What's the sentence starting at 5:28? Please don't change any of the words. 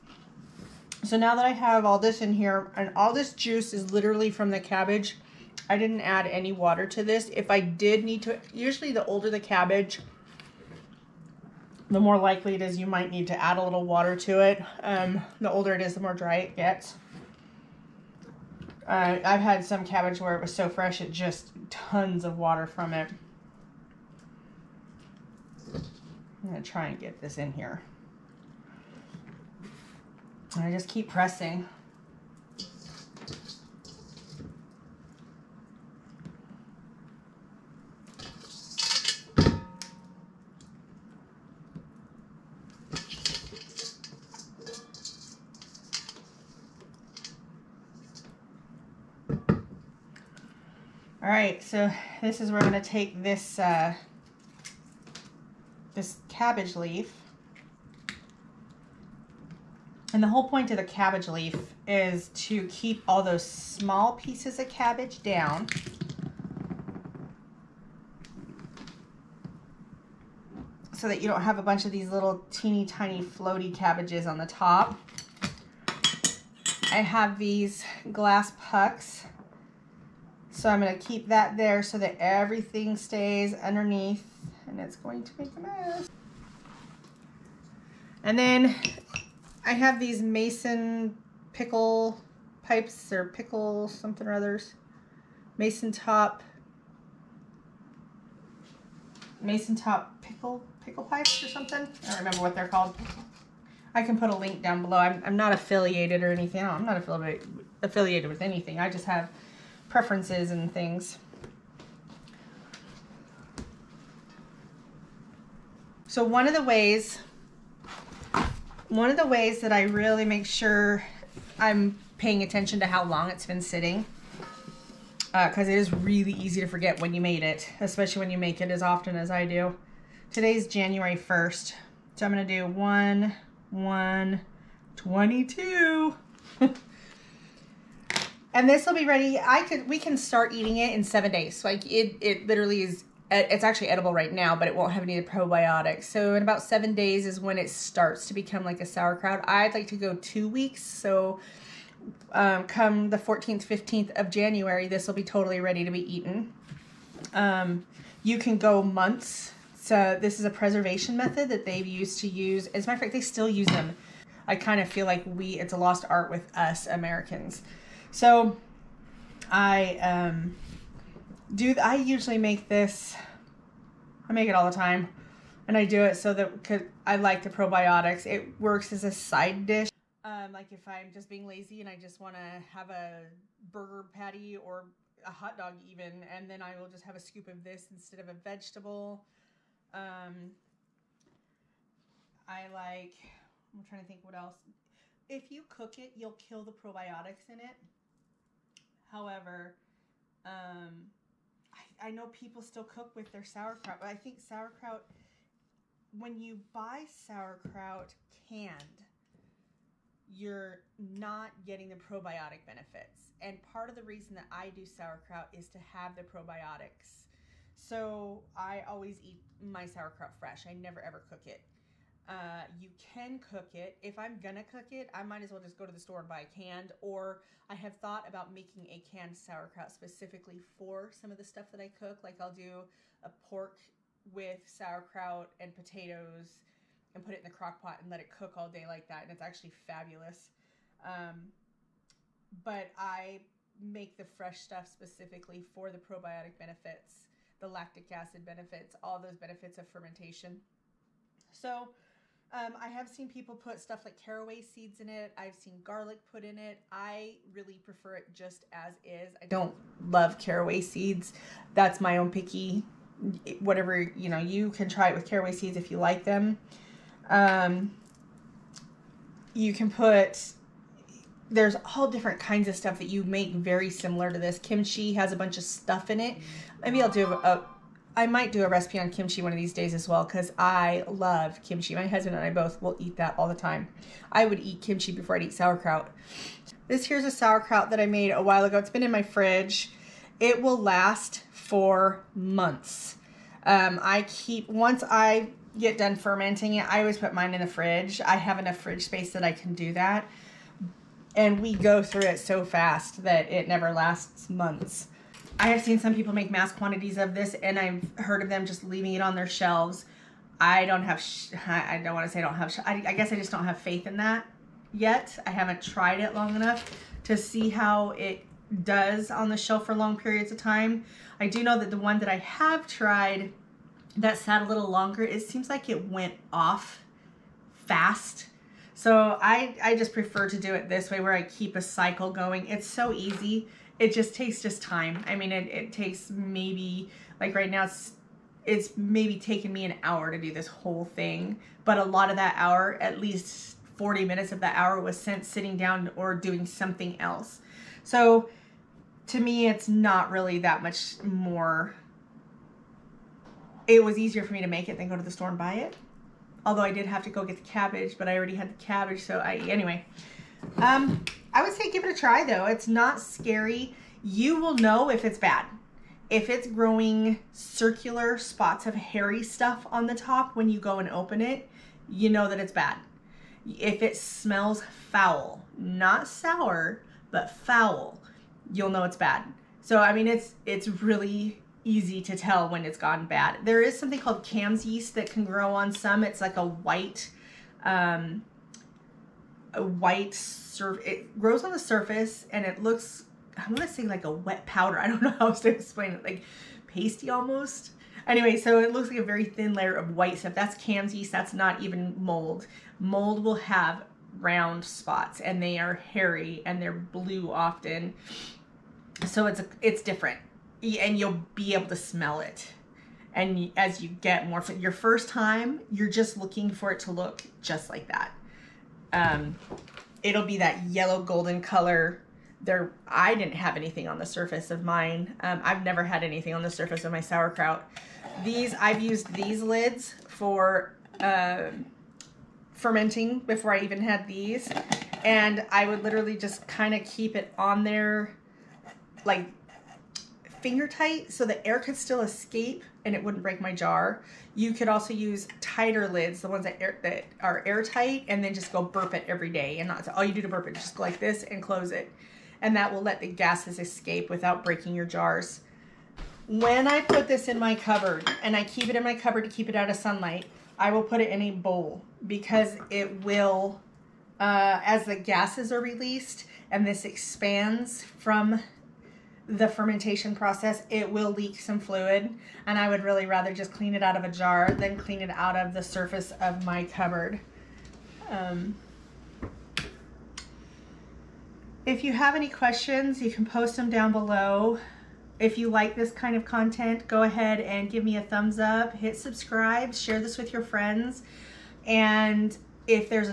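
So I, I just prefer to do it this way where I keep a cycle going.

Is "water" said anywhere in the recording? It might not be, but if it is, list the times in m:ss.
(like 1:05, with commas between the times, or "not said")
0:06, 0:13, 0:22.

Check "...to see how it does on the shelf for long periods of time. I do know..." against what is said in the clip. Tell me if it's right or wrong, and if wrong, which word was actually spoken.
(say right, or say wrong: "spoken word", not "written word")
right.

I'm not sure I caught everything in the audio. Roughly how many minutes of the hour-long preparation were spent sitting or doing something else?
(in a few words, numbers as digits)
40.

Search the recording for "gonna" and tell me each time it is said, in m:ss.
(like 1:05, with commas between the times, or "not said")
3:44, 6:33.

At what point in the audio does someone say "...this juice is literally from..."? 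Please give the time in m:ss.
0:03.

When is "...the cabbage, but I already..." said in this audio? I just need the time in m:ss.
5:57.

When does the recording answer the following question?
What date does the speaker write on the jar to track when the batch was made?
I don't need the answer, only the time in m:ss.
2:12.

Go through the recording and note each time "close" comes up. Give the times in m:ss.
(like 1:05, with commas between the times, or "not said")
7:31.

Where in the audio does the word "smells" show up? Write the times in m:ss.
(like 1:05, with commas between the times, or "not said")
6:14, 6:51.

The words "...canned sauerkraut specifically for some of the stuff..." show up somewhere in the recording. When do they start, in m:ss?
3:49.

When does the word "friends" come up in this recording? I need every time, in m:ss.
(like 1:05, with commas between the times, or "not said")
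8:10.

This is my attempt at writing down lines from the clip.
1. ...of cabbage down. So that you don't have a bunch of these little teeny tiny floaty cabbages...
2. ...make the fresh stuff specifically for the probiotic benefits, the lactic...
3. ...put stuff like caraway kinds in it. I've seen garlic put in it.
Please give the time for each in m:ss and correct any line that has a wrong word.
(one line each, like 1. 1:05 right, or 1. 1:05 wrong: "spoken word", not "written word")
1. 1:04 right
2. 4:03 right
3. 4:13 wrong: "seeds", not "kinds".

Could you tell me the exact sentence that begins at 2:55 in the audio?
And I do it so that, cause I like the probiotics.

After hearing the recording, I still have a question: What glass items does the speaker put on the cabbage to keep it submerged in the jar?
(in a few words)
glass pucks.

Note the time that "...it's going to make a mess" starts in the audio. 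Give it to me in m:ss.
1:24.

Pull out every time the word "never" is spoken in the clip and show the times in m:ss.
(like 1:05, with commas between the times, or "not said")
3:40, 5:03, 7:05.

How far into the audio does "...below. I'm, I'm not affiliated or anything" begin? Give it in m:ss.
1:44.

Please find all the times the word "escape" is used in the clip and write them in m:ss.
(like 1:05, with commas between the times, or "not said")
7:22, 7:33.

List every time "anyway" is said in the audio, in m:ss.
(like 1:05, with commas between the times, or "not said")
5:59, 6:38.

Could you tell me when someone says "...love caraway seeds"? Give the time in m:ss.
4:20.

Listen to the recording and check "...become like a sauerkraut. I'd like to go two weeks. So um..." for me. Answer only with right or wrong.
right.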